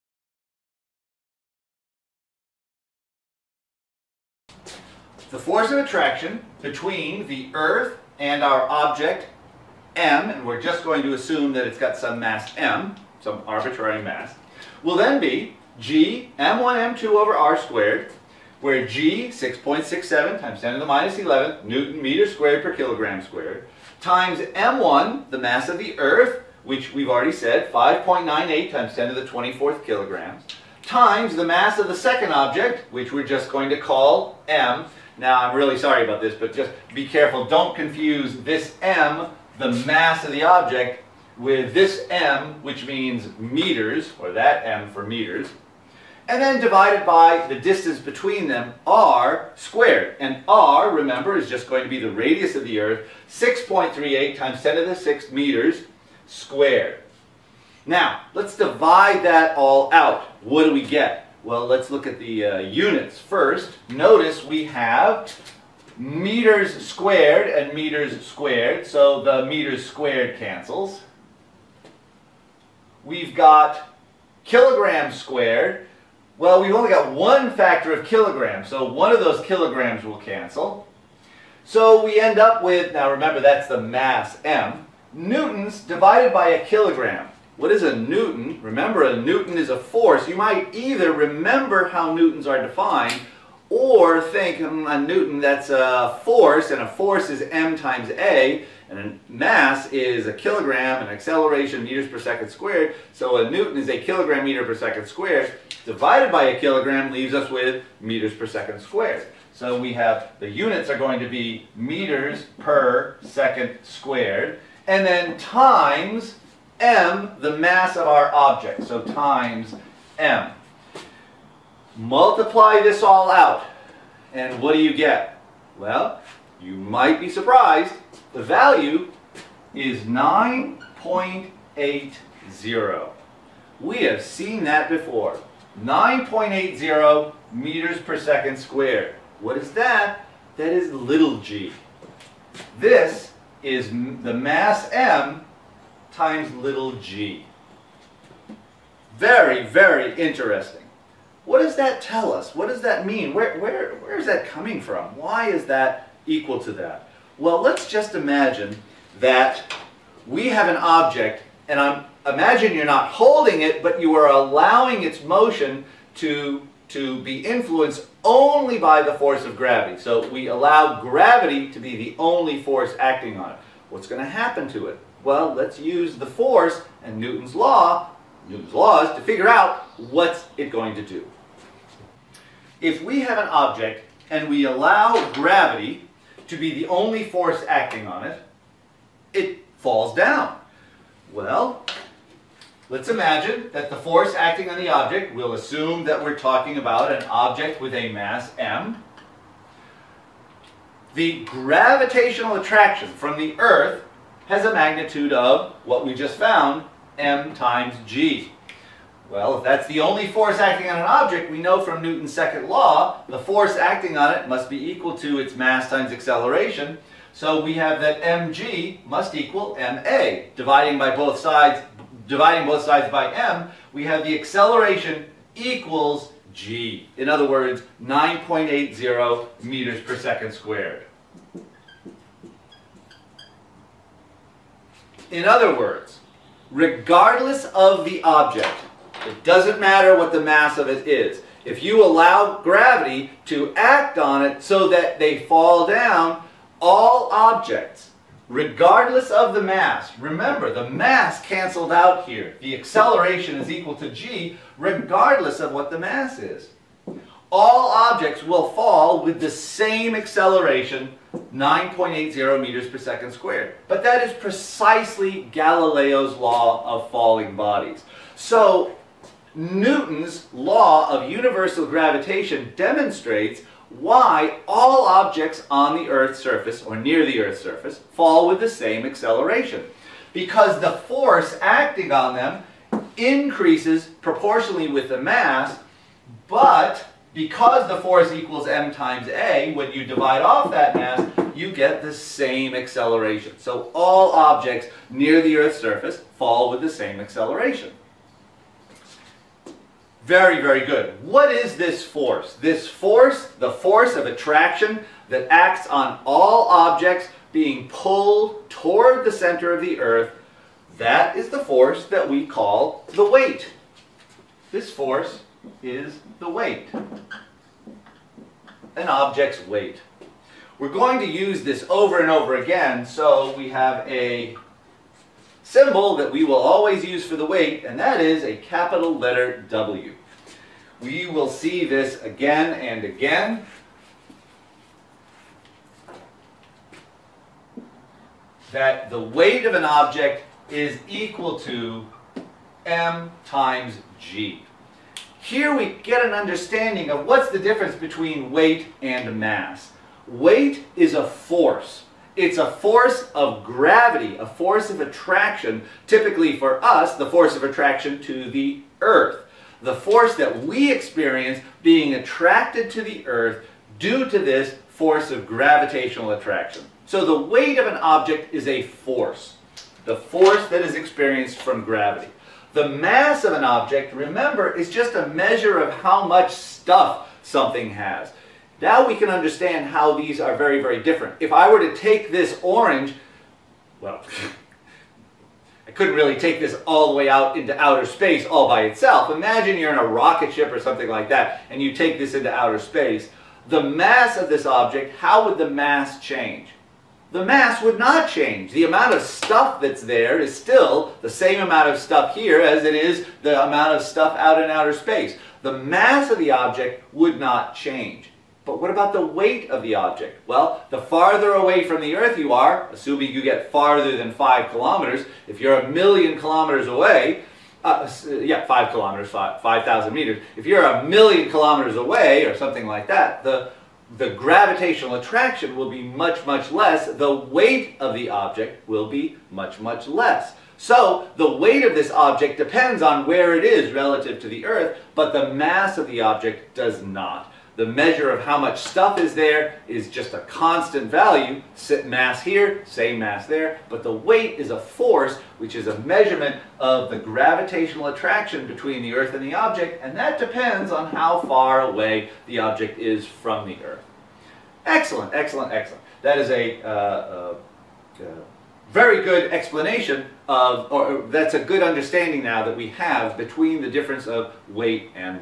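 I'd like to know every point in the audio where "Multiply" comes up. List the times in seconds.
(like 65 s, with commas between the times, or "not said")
121 s.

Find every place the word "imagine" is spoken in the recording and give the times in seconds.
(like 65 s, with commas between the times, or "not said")
158 s, 162 s, 193 s, 389 s.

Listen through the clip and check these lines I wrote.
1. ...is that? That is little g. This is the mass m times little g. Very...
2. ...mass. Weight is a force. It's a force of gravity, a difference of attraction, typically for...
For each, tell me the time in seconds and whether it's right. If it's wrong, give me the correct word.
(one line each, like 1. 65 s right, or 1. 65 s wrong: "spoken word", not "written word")
1. 139 s right
2. 349 s wrong: "force", not "difference".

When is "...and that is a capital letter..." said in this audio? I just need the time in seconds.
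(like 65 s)
327 s.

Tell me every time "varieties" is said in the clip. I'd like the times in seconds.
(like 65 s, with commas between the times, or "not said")
not said.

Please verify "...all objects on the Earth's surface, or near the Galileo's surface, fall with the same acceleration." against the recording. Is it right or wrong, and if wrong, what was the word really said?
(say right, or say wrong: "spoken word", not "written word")
wrong: "Earth", not "Galileo".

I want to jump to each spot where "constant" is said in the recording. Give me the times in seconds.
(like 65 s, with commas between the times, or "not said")
440 s.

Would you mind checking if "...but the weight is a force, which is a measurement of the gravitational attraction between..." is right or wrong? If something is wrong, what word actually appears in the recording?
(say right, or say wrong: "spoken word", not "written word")
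right.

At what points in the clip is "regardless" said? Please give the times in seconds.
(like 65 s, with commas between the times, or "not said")
236 s, 248 s, 254 s.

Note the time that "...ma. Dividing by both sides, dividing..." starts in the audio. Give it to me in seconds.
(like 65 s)
219 s.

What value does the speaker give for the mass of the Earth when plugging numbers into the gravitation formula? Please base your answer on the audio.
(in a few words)
5.98 x 10^24 kg.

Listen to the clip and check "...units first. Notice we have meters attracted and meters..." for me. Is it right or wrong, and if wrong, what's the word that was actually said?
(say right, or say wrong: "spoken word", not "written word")
wrong: "squared", not "attracted".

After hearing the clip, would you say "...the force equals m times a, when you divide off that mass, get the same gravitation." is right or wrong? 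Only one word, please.
wrong.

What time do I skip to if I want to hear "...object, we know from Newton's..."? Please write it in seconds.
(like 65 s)
211 s.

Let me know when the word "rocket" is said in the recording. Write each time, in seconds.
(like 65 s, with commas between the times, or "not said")
390 s.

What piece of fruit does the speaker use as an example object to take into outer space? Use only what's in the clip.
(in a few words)
orange.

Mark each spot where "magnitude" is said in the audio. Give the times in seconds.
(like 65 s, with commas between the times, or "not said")
204 s.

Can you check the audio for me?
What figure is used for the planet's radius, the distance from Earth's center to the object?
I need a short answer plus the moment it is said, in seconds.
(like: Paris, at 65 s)
6.38 x 10^6 m, at 53 s.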